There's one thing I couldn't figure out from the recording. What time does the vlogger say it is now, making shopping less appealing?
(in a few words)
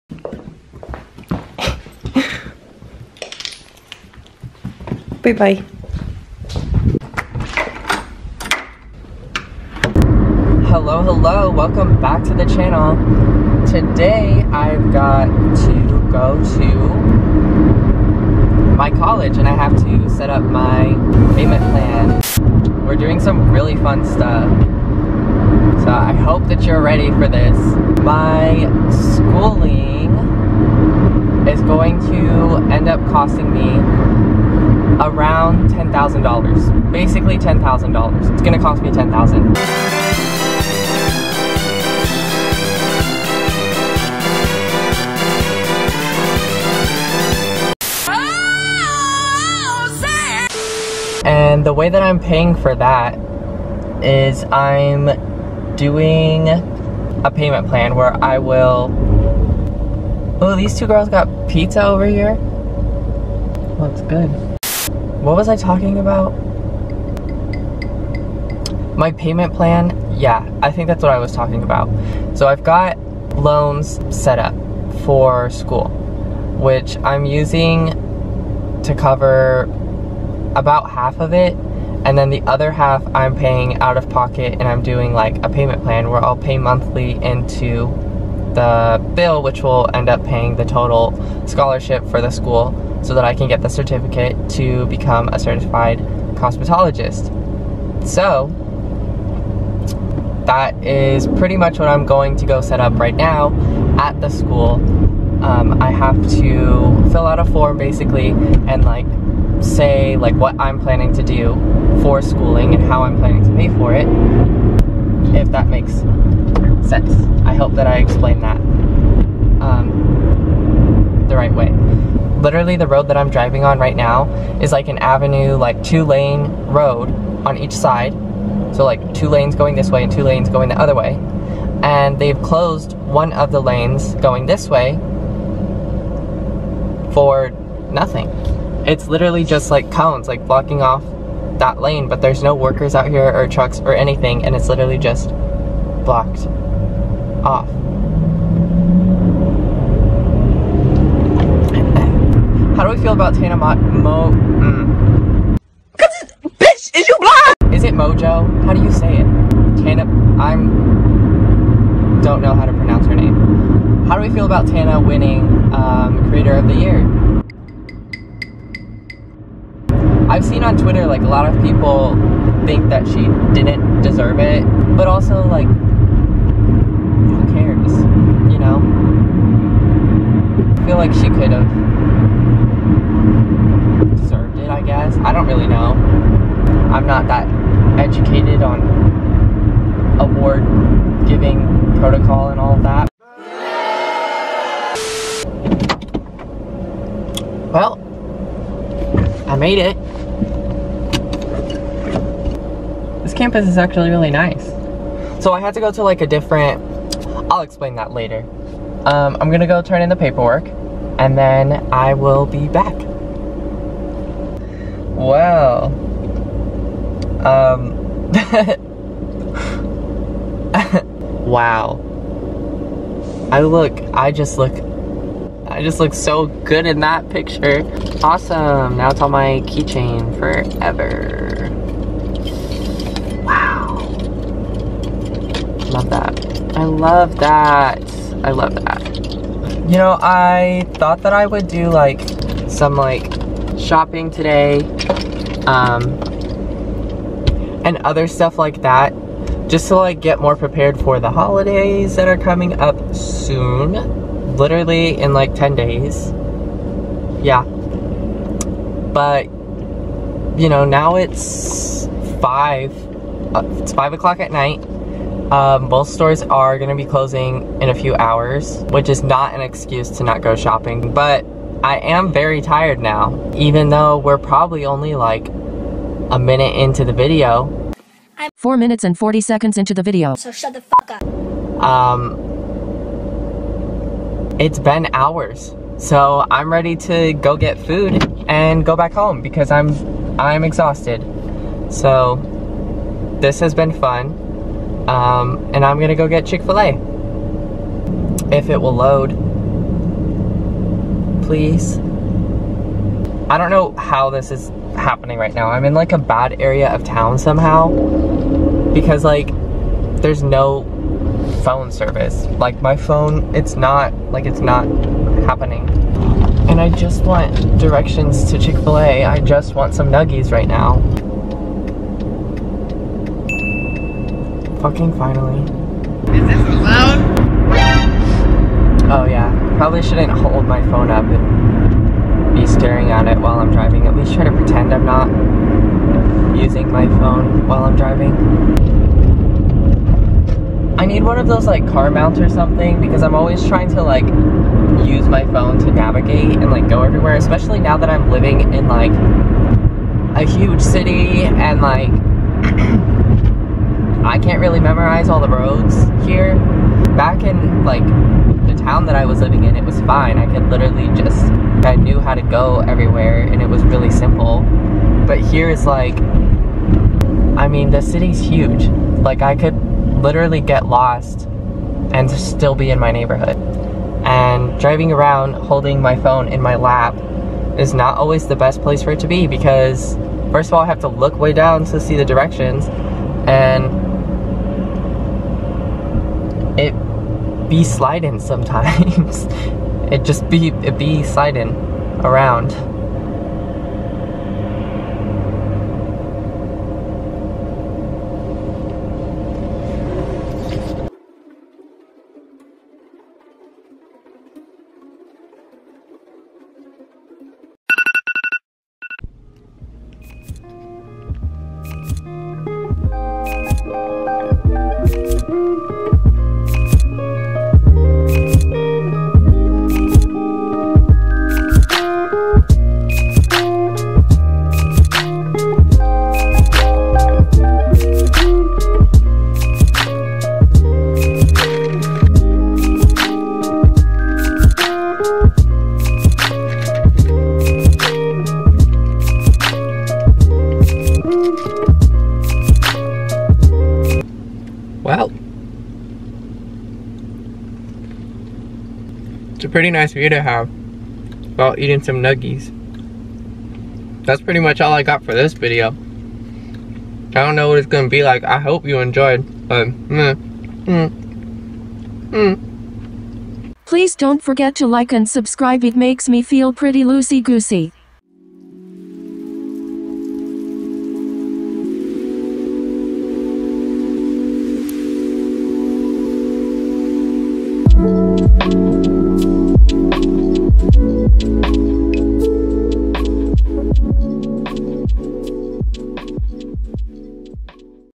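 5 o'clock.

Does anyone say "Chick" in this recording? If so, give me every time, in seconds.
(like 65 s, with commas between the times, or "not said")
296 s, 318 s.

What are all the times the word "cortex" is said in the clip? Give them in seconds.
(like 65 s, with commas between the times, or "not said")
not said.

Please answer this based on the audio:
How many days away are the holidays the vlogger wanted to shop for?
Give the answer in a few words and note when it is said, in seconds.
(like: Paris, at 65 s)
10 days, at 255 s.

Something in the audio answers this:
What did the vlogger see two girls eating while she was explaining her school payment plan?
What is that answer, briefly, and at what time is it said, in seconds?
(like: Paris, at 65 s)
pizza, at 61 s.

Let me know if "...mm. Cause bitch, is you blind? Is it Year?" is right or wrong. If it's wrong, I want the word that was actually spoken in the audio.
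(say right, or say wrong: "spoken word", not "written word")
wrong: "Mojo", not "Year".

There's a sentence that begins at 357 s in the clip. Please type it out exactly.
Back in like town that I was living in, it was fine.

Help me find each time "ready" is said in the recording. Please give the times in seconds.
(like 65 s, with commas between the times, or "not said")
26 s, 286 s.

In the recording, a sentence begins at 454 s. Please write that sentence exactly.
That's pretty much all I got for this video.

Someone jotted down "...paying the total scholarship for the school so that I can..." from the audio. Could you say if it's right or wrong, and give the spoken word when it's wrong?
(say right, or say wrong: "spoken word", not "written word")
right.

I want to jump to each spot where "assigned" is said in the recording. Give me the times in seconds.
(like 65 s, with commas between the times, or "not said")
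not said.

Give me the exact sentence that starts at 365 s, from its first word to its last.
But here is like, I mean, the city's huge.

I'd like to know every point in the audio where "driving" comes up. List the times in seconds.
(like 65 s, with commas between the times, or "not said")
123 s, 333 s, 337 s, 374 s.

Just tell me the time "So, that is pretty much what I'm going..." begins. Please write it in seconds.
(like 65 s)
98 s.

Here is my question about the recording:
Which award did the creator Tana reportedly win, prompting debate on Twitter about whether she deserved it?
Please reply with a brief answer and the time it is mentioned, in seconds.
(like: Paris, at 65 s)
Creator of the Year, at 166 s.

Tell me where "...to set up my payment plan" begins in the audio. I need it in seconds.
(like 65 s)
19 s.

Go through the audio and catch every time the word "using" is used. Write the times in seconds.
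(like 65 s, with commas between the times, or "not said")
77 s, 336 s.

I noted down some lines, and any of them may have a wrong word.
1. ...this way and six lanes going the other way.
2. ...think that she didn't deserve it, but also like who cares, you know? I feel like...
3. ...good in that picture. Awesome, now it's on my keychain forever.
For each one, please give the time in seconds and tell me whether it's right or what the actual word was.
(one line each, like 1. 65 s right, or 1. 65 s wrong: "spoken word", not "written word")
1. 129 s wrong: "two", not "six"
2. 172 s right
3. 226 s right.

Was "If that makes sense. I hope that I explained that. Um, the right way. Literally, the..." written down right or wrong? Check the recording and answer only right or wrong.
right.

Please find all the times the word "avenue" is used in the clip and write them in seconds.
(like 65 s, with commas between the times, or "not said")
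124 s.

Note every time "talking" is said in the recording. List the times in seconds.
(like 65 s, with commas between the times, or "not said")
65 s, 71 s.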